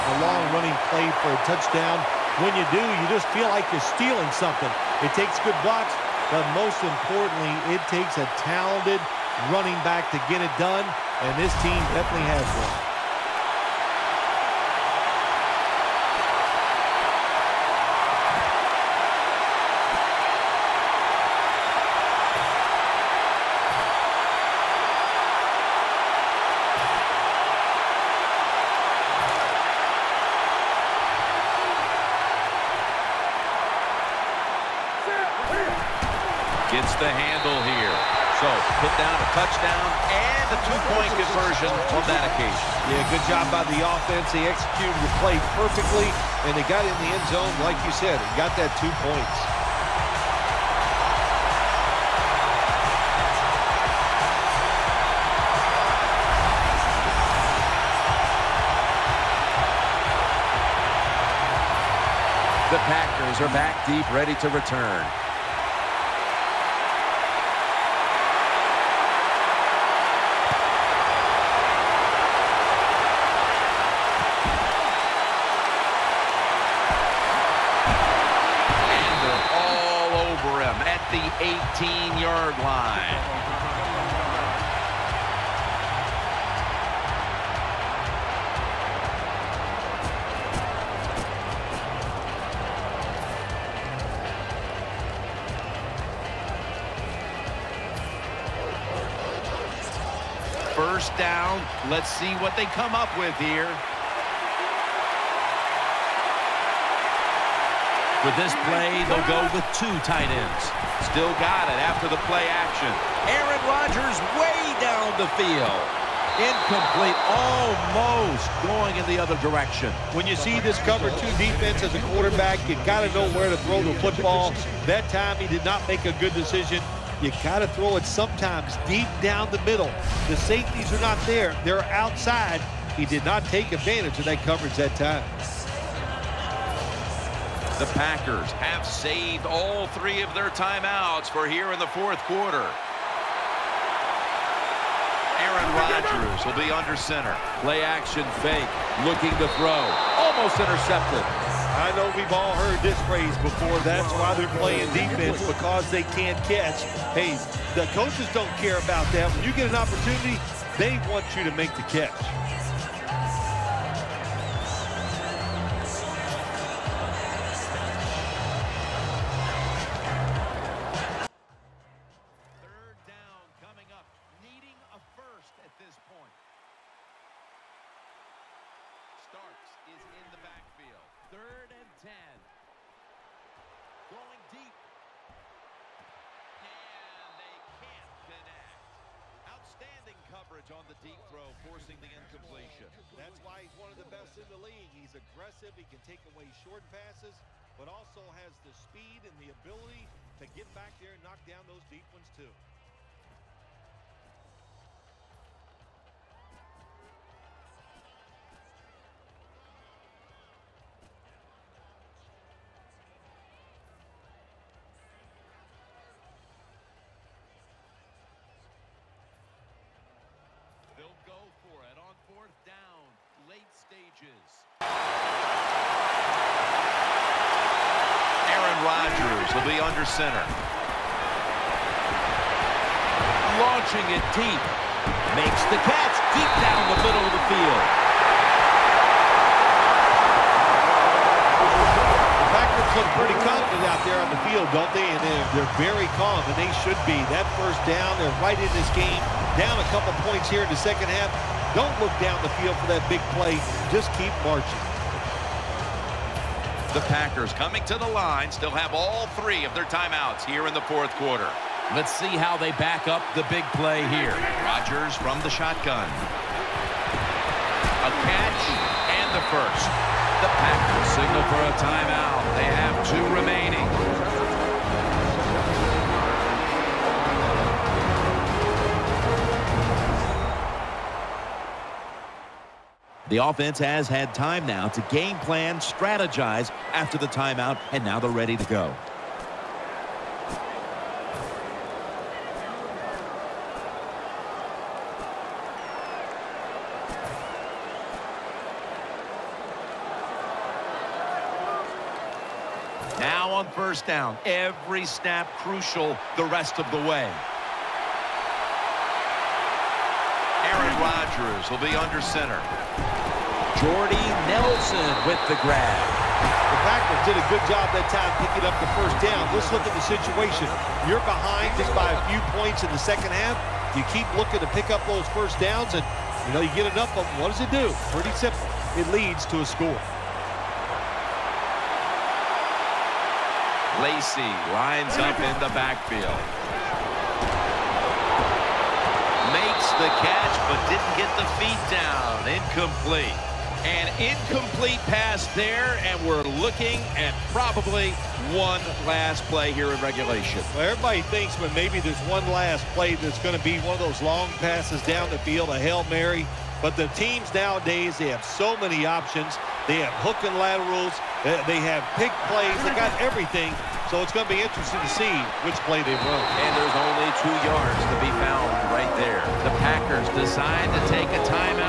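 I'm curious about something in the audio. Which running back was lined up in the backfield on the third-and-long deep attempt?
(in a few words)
Starks.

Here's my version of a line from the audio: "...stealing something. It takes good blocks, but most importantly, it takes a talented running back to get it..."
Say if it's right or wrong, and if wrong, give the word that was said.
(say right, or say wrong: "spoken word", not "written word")
right.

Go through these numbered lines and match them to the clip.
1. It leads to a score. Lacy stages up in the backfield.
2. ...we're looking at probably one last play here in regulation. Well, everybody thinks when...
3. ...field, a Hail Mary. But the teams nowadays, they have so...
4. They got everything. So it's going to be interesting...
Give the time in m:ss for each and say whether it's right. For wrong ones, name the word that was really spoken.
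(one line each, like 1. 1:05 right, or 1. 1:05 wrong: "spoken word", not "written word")
1. 5:28 wrong: "lines", not "stages"
2. 5:46 right
3. 5:55 right
4. 6:02 right.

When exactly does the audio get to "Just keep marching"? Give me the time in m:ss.
4:13.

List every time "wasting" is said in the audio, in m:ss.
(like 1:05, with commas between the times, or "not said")
not said.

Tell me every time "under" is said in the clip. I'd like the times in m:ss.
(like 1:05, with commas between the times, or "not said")
2:26, 3:49, 5:11.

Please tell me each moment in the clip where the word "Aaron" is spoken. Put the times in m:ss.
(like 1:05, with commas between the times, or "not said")
1:53, 2:25, 3:48, 5:10.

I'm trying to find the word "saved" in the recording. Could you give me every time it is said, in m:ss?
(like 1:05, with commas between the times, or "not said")
2:18.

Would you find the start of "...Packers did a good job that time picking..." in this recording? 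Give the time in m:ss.
5:16.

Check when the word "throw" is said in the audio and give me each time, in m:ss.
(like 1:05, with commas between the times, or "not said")
2:03, 2:07, 2:29, 3:11.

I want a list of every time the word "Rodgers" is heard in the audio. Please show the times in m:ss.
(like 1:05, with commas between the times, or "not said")
1:53, 2:25, 3:48, 4:24, 5:10.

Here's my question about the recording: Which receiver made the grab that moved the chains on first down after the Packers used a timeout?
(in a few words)
Jordy Nelson.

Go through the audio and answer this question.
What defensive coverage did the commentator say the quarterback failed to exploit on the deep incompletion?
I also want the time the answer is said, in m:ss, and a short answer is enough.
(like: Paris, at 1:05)
cover two, at 2:00.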